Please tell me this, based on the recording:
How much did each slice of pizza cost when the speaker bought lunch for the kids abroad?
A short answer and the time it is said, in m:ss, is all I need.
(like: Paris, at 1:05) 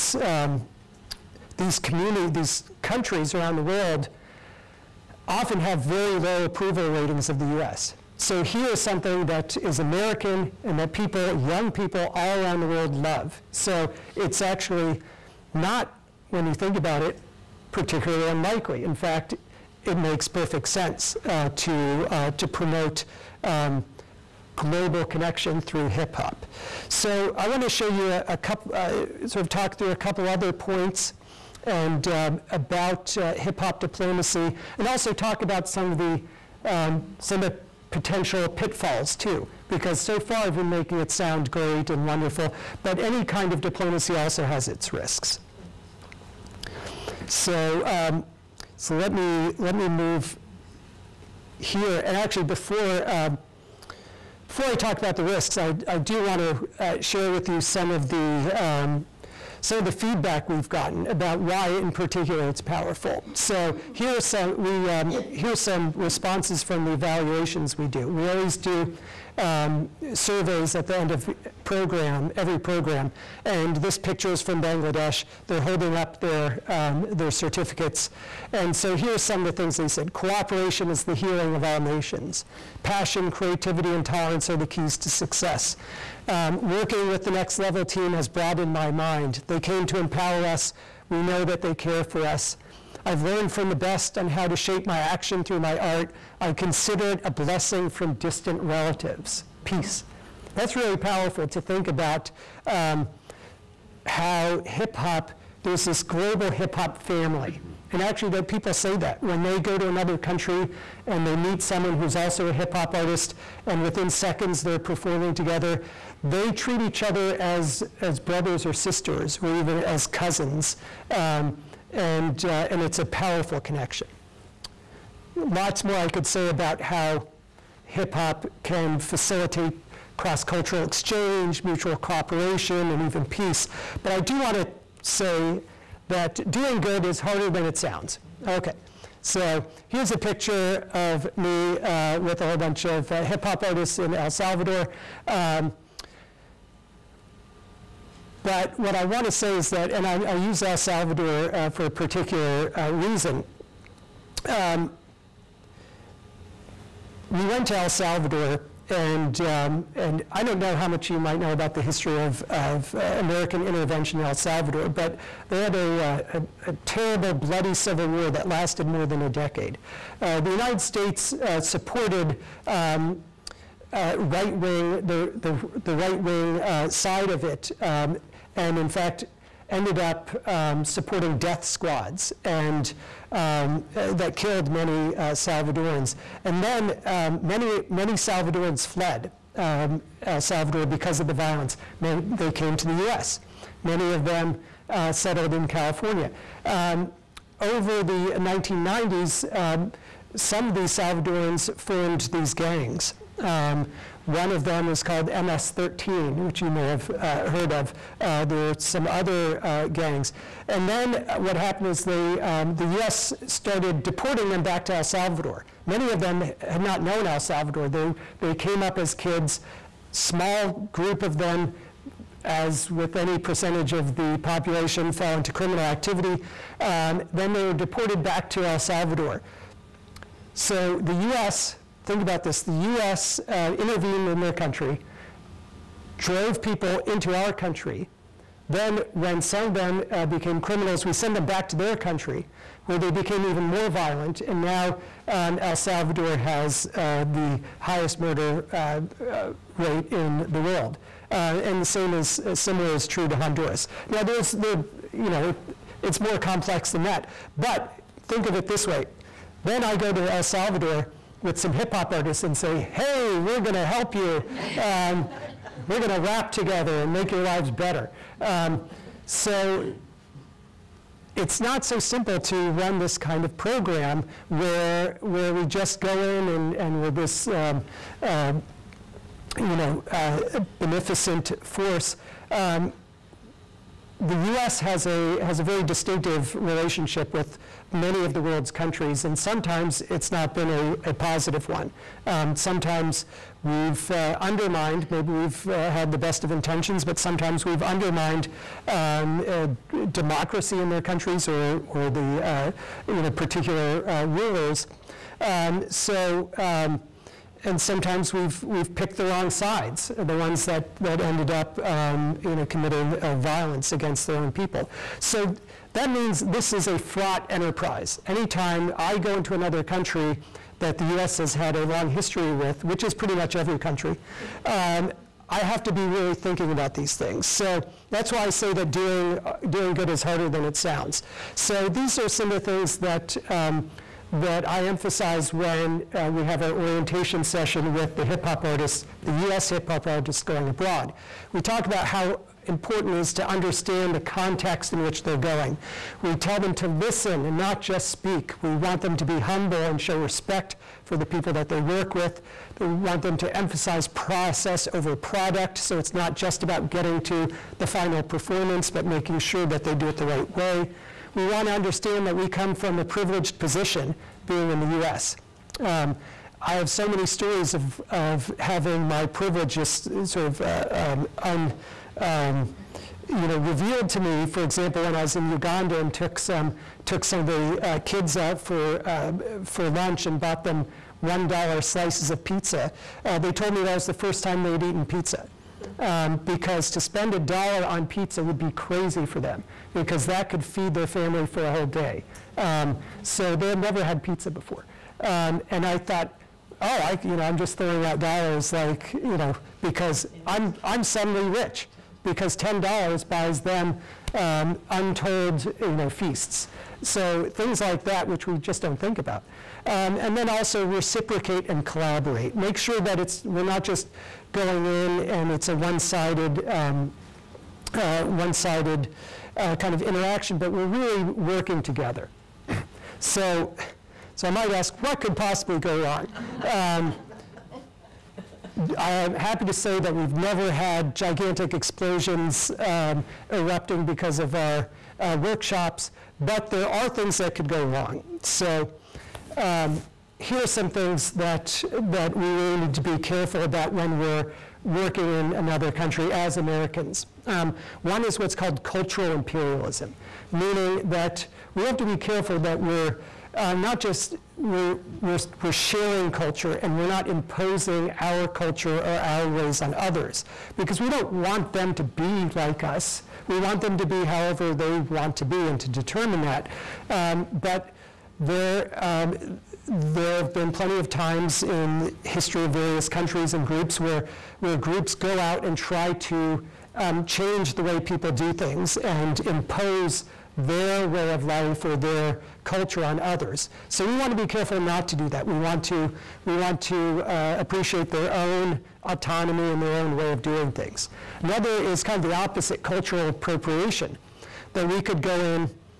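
$1, at 6:21.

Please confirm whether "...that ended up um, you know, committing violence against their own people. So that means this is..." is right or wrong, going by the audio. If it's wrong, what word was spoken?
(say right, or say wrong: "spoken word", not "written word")
right.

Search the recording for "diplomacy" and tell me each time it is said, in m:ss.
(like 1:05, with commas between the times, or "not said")
0:33, 0:43.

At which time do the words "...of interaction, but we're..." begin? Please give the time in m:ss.
6:59.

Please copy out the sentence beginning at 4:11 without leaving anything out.
Uh, and the same is similar is true to Honduras.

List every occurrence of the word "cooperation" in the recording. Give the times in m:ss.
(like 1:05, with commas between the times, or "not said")
1:20, 2:11.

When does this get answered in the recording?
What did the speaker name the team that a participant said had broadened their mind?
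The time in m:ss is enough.
1:27.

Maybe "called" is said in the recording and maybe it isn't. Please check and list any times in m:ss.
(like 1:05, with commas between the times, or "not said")
3:25, 7:28.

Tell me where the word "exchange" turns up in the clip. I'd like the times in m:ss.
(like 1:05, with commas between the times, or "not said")
2:10.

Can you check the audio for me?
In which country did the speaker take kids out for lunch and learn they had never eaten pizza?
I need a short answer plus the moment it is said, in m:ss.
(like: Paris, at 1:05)
Uganda, at 6:15.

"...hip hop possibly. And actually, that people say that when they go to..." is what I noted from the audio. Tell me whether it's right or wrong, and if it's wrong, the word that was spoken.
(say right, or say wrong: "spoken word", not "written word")
wrong: "family", not "possibly".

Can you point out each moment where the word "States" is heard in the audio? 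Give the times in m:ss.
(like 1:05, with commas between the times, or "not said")
2:50.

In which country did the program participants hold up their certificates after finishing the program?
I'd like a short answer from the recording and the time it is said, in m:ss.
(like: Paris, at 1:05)
Bangladesh, at 1:14.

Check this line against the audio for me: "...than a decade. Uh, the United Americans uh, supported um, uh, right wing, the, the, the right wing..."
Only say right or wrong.
wrong.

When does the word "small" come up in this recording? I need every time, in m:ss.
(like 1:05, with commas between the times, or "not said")
3:40.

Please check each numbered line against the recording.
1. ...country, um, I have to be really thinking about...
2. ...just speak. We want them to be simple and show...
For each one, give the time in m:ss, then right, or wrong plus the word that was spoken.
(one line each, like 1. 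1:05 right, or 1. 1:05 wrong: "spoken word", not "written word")
1. 5:23 right
2. 5:47 wrong: "humble", not "simple".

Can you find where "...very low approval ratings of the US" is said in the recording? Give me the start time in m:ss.
0:05.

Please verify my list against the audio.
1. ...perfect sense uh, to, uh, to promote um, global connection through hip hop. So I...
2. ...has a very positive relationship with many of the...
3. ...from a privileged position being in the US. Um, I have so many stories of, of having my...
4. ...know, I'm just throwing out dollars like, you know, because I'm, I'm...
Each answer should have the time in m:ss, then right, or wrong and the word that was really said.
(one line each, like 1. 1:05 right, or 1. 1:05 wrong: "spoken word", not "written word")
1. 0:20 right
2. 4:45 wrong: "distinctive", not "positive"
3. 6:02 right
4. 6:37 right.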